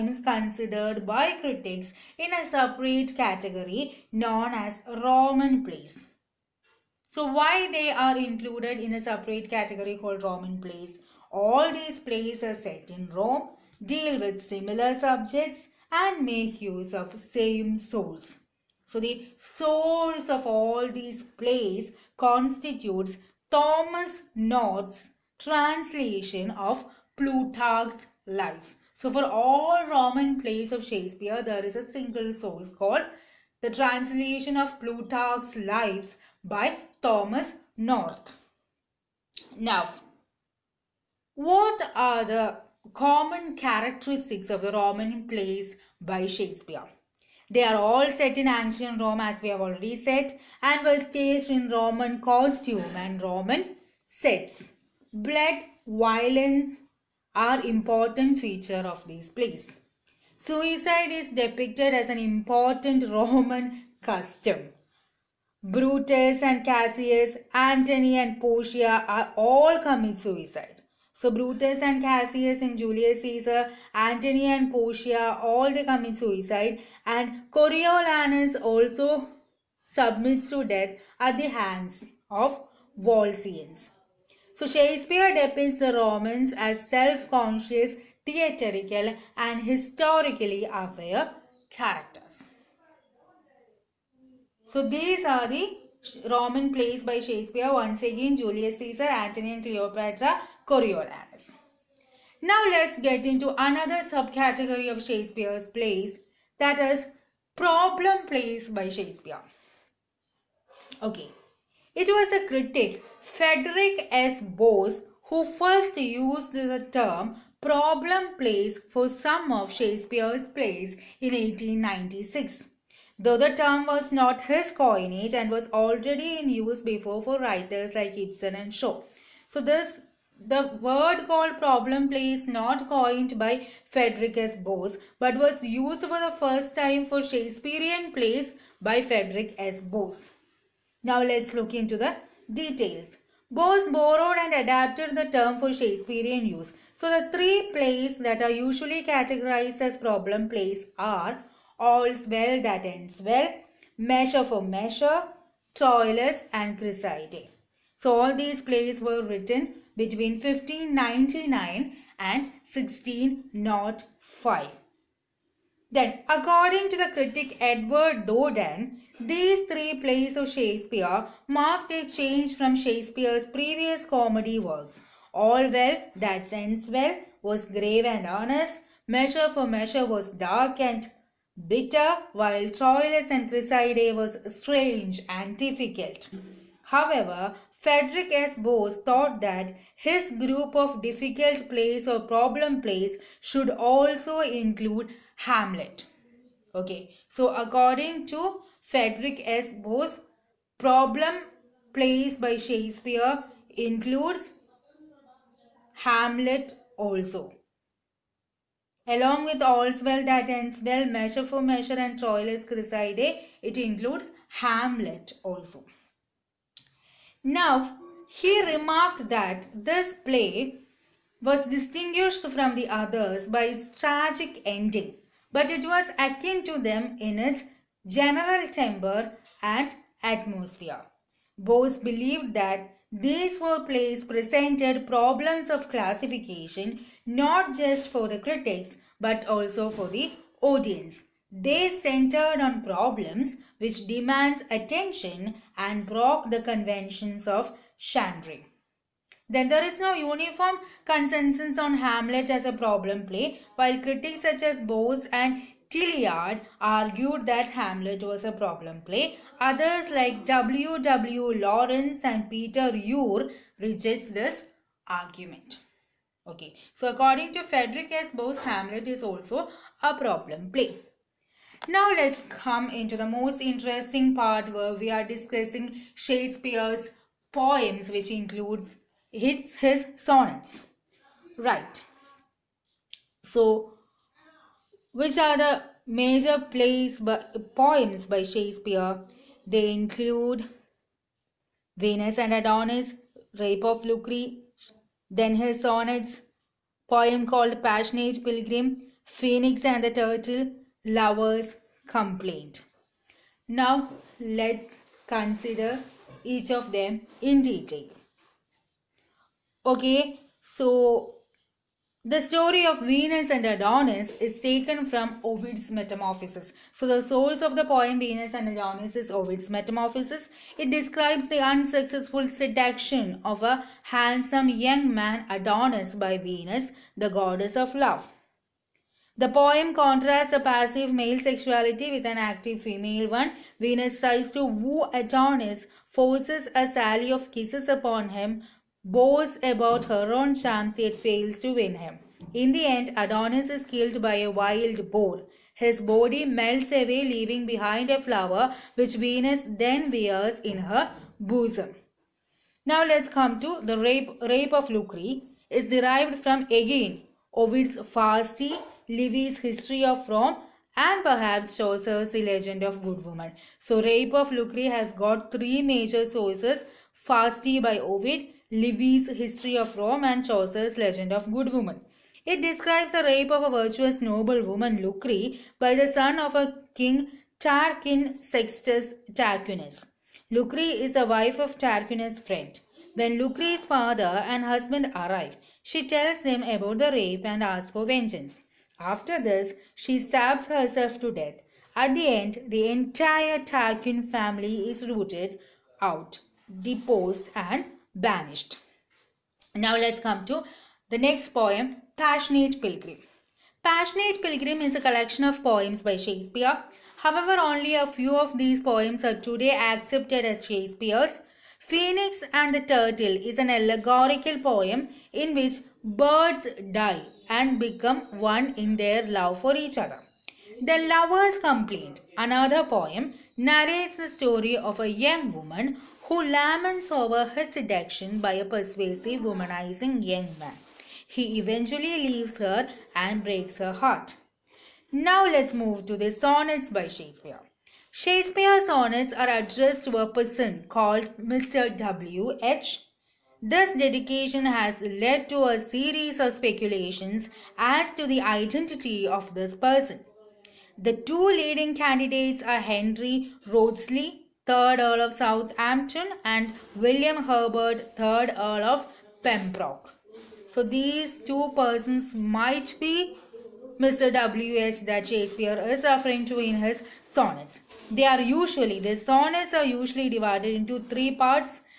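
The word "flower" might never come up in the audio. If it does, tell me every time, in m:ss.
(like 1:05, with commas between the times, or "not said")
5:48.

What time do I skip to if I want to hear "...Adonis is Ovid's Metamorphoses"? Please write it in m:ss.
5:18.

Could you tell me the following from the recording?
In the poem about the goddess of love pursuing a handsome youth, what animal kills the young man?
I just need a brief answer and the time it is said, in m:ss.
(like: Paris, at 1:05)
wild boar, at 5:44.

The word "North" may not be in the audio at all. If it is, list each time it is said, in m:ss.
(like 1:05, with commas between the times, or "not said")
0:24, 0:37.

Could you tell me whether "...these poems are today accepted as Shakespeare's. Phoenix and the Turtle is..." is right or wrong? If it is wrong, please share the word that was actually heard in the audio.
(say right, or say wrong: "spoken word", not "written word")
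right.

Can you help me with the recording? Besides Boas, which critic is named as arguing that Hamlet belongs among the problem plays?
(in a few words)
Tillyard.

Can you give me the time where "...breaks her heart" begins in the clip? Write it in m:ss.
7:13.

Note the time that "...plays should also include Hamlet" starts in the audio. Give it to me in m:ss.
3:12.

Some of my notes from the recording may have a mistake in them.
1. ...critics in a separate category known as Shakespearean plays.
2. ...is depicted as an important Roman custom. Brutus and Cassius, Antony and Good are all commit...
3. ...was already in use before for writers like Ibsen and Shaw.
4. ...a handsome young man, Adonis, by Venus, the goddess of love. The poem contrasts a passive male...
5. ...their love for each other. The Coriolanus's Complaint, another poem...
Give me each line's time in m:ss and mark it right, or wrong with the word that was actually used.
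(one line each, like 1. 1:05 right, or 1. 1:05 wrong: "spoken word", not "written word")
1. 0:01 wrong: "Roman", not "Shakespearean"
2. 1:01 wrong: "Portia", not "Good"
3. 2:05 right
4. 5:23 right
5. 6:59 wrong: "Lover", not "Coriolanus".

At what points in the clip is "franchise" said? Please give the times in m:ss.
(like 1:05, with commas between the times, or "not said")
not said.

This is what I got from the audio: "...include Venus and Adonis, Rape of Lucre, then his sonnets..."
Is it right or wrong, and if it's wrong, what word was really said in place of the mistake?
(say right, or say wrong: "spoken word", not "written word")
right.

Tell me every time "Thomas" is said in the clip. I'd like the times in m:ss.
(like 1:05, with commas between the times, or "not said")
0:23, 0:37.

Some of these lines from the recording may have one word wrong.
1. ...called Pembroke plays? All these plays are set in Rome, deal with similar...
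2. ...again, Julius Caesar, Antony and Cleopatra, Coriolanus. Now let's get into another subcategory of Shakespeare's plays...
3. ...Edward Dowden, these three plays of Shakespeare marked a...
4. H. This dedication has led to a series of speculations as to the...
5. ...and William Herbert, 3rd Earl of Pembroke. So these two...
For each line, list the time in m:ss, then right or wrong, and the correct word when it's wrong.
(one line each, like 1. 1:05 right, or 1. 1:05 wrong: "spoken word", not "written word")
1. 0:09 wrong: "Roman", not "Pembroke"
2. 1:38 right
3. 2:47 right
4. 7:22 right
5. 7:36 right.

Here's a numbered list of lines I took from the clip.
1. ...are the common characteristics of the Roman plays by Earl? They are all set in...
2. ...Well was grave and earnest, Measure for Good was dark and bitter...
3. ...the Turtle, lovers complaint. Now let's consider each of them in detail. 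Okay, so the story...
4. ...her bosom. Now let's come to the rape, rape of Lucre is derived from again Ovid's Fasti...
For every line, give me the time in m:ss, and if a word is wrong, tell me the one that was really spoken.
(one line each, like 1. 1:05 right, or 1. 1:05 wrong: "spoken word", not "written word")
1. 0:41 wrong: "Shakespeare", not "Earl"
2. 2:56 wrong: "Measure", not "Good"
3. 5:00 right
4. 5:50 right.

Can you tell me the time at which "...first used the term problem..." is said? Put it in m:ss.
1:55.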